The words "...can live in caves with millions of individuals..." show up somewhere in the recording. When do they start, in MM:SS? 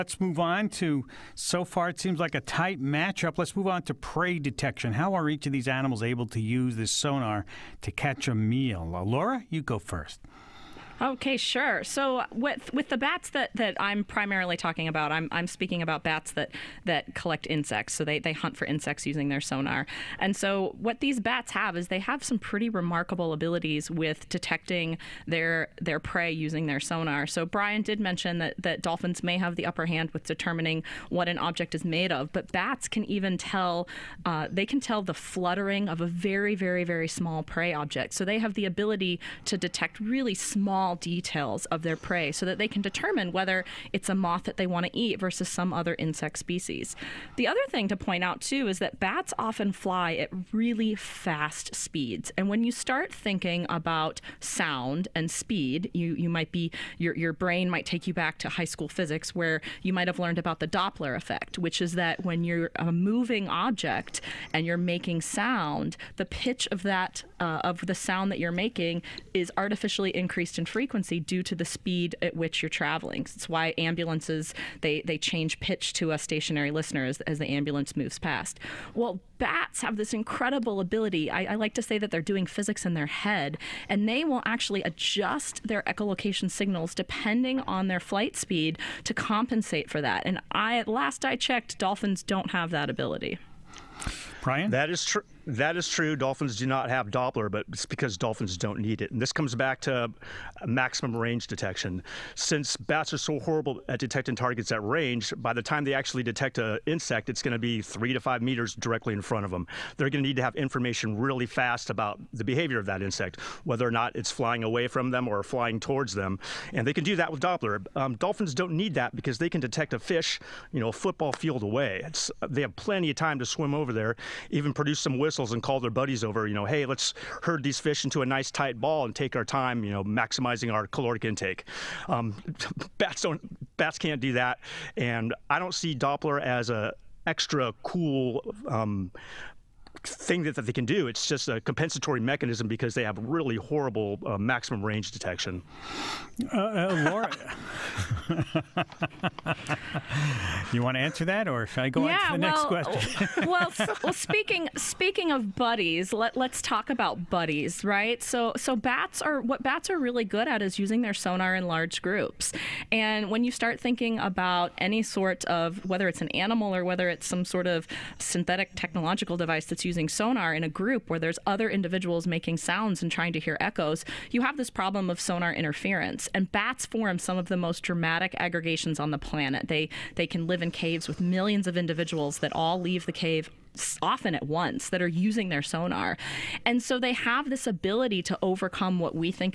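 03:00.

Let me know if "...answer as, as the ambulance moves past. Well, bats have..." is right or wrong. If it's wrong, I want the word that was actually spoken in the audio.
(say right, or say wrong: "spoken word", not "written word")
wrong: "listener", not "answer".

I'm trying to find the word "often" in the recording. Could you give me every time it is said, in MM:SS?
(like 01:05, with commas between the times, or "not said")
00:49, 03:04.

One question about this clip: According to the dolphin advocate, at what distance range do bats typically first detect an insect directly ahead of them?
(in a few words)
3 to 5 meters.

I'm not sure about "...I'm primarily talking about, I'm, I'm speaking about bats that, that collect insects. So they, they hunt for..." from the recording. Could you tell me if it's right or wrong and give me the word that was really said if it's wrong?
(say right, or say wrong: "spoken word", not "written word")
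right.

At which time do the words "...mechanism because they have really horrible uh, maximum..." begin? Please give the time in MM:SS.
02:22.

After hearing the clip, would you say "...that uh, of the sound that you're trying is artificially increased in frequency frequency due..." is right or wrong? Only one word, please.
wrong.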